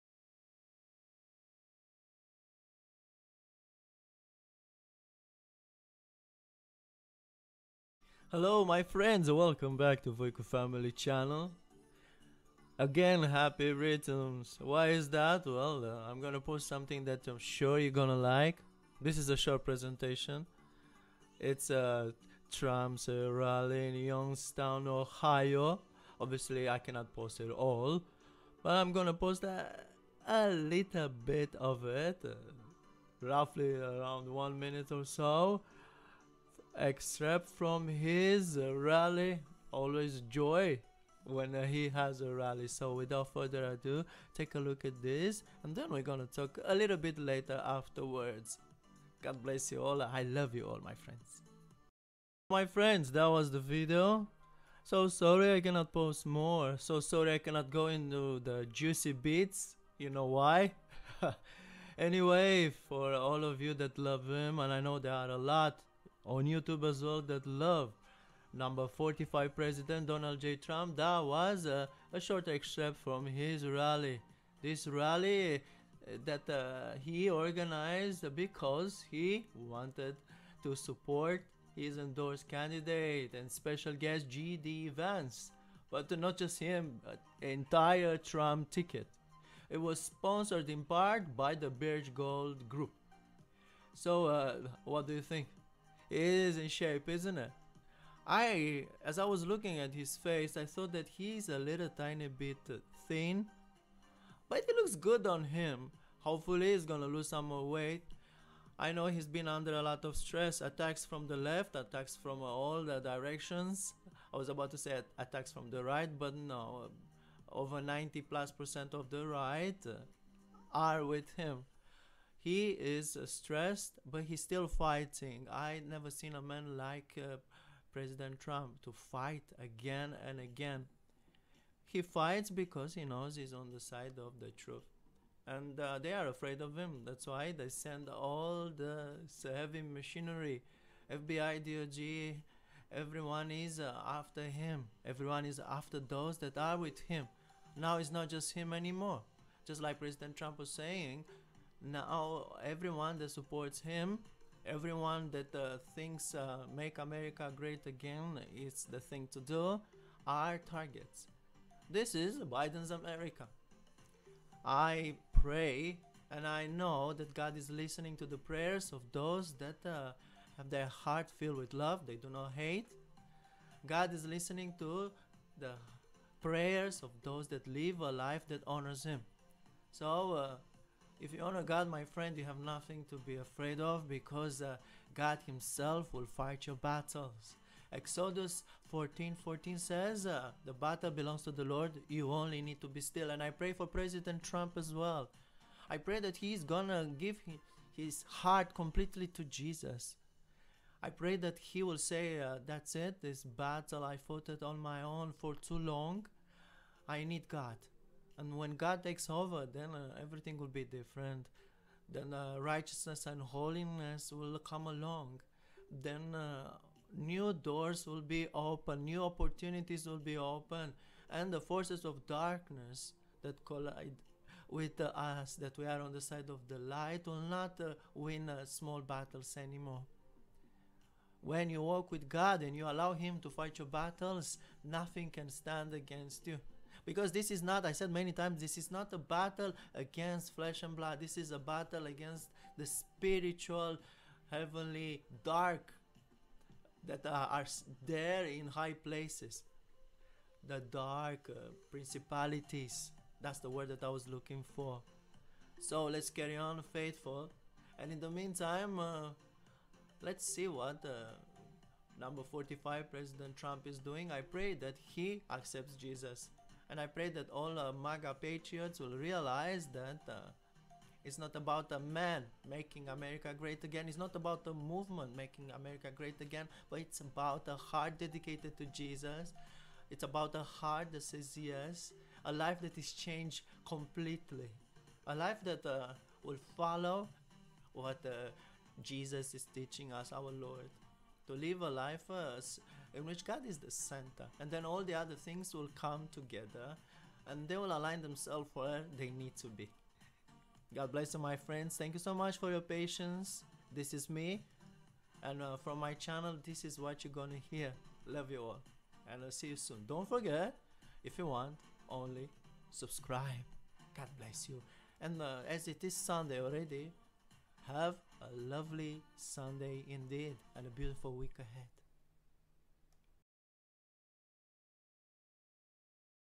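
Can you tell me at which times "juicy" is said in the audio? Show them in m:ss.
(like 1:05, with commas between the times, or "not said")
0:58.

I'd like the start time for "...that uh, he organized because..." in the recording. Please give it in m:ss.
1:16.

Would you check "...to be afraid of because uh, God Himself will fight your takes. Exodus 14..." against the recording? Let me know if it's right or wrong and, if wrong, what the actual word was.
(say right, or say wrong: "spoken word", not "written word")
wrong: "battles", not "takes".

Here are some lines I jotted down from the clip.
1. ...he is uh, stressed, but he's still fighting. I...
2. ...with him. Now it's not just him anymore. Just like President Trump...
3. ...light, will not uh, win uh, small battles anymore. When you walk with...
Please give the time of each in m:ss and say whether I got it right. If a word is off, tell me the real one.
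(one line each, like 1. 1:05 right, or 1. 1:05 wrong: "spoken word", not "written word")
1. 2:02 right
2. 2:26 right
3. 3:46 right.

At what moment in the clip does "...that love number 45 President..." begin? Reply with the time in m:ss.
1:07.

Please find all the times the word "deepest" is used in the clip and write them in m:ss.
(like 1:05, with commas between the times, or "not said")
not said.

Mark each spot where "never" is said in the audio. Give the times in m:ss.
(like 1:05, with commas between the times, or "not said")
2:05.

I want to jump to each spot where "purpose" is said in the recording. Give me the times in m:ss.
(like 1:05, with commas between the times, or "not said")
not said.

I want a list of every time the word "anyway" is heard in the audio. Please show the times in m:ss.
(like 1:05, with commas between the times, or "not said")
1:01.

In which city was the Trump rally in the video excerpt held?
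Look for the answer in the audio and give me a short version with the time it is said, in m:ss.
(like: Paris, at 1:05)
Youngstown, Ohio, at 0:23.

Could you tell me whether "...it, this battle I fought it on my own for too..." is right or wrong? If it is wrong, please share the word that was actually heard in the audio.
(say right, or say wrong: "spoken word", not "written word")
right.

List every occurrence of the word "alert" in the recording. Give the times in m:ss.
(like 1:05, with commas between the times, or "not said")
not said.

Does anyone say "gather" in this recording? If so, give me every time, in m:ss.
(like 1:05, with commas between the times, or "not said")
not said.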